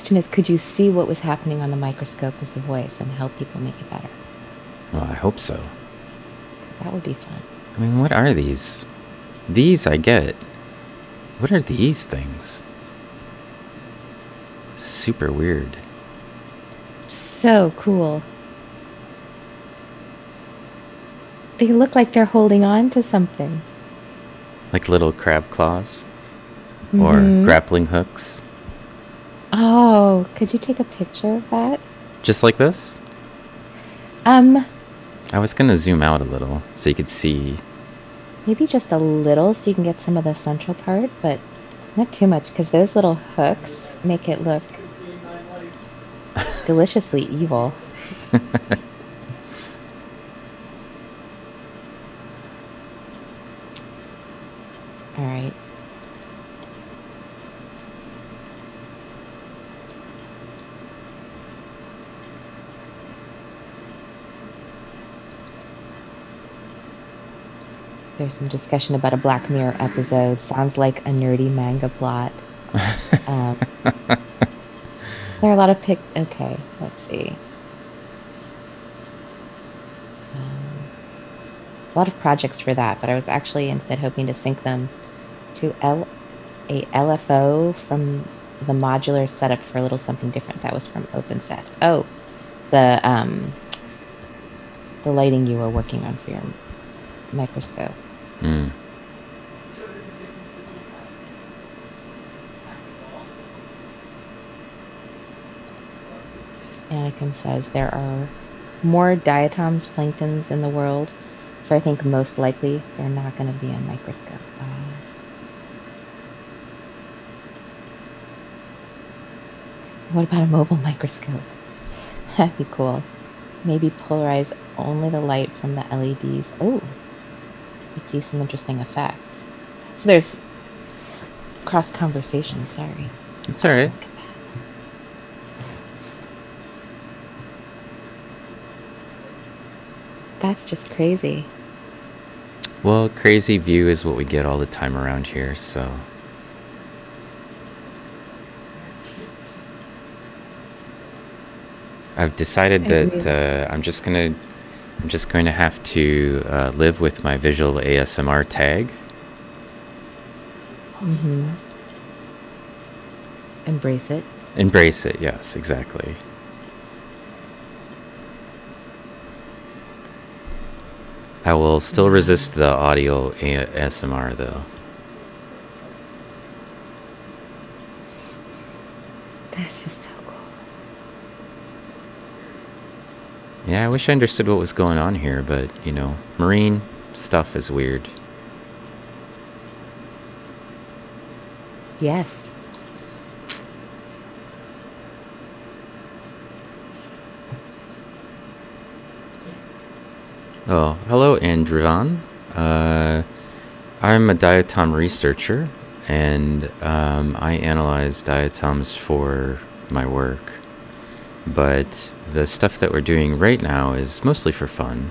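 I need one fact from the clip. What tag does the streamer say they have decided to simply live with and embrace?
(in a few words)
Visual ASMR.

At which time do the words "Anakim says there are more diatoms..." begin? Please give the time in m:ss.
1:46.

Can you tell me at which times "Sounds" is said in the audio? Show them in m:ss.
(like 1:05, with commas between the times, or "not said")
1:10.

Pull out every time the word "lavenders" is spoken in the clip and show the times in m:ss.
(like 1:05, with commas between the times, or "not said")
not said.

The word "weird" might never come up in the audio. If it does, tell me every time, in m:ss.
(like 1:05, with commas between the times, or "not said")
0:15, 3:07.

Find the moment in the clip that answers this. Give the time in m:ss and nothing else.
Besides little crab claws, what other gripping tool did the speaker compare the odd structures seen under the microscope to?
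0:27.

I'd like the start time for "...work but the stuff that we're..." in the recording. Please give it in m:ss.
3:30.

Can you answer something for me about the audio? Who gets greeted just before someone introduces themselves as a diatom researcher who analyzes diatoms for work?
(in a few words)
Andrivan.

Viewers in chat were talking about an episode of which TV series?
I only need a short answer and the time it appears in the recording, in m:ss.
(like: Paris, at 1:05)
Black Mirror, at 1:09.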